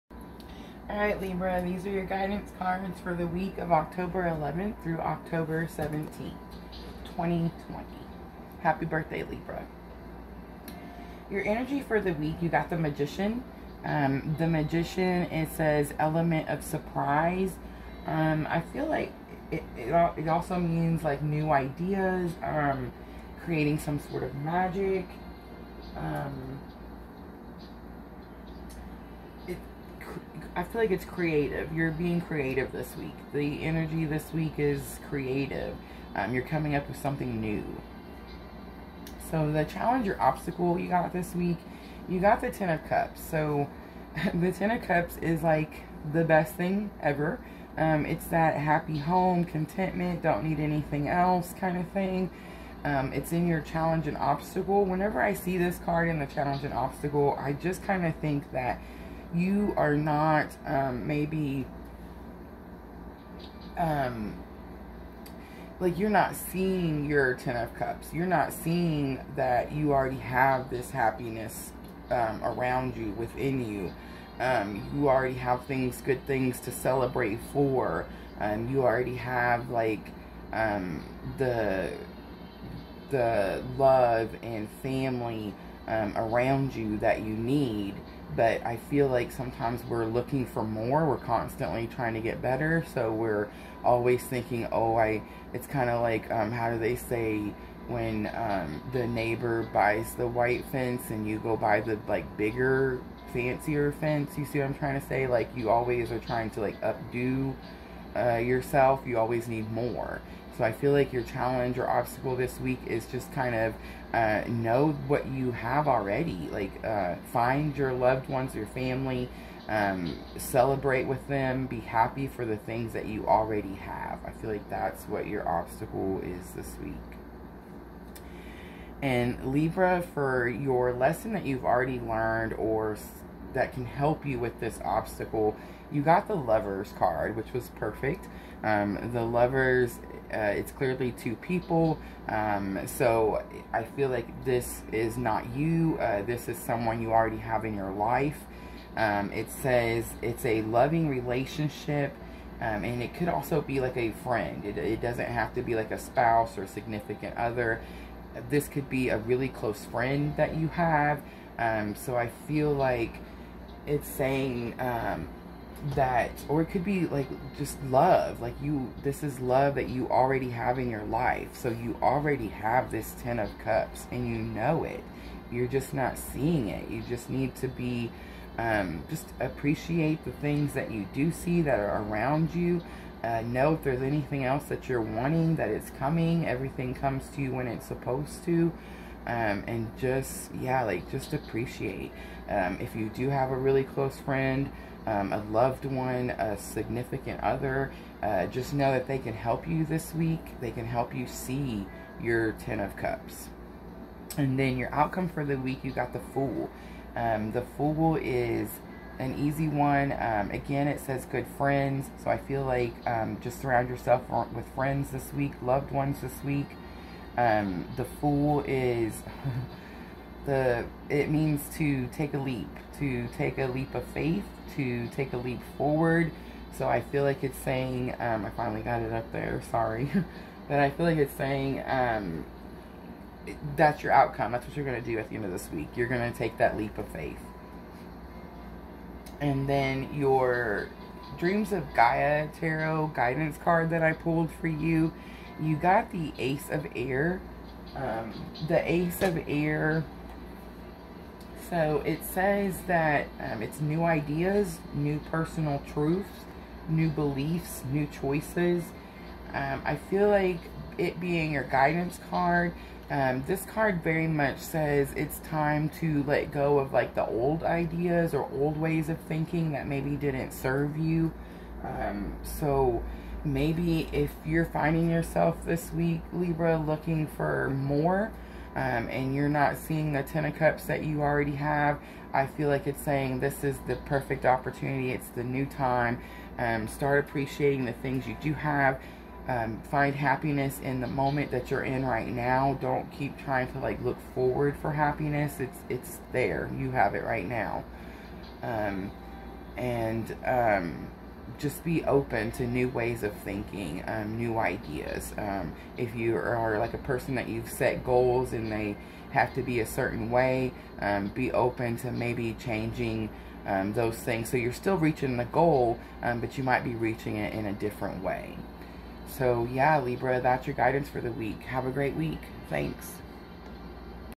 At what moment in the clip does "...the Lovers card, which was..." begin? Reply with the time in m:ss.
2:16.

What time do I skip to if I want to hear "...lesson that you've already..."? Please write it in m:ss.
2:10.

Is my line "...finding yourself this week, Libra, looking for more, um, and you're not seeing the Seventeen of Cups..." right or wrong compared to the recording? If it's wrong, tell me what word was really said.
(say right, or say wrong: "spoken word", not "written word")
wrong: "Ten", not "Seventeen".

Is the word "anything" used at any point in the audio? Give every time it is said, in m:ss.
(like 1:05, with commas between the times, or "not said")
0:50, 3:04.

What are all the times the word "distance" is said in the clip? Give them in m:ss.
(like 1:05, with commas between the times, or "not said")
not said.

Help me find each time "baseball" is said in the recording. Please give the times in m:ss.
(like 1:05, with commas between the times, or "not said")
not said.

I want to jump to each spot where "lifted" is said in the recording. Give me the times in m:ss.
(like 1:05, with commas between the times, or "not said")
not said.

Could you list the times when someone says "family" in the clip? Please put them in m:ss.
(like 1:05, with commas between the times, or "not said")
1:24, 1:58.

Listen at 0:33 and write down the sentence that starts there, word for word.
The energy this week is creative.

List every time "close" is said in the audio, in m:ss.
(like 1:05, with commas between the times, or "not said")
2:39, 3:13.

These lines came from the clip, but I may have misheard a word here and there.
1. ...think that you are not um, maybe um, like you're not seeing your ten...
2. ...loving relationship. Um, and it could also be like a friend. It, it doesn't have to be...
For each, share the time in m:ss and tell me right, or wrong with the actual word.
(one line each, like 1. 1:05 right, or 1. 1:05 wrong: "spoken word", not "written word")
1. 0:58 right
2. 2:30 right.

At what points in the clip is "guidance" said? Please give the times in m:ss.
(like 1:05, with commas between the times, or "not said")
0:02, 4:03, 4:21, 5:20.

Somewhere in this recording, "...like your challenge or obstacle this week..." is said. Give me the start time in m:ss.
1:50.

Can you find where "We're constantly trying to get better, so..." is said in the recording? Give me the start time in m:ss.
1:31.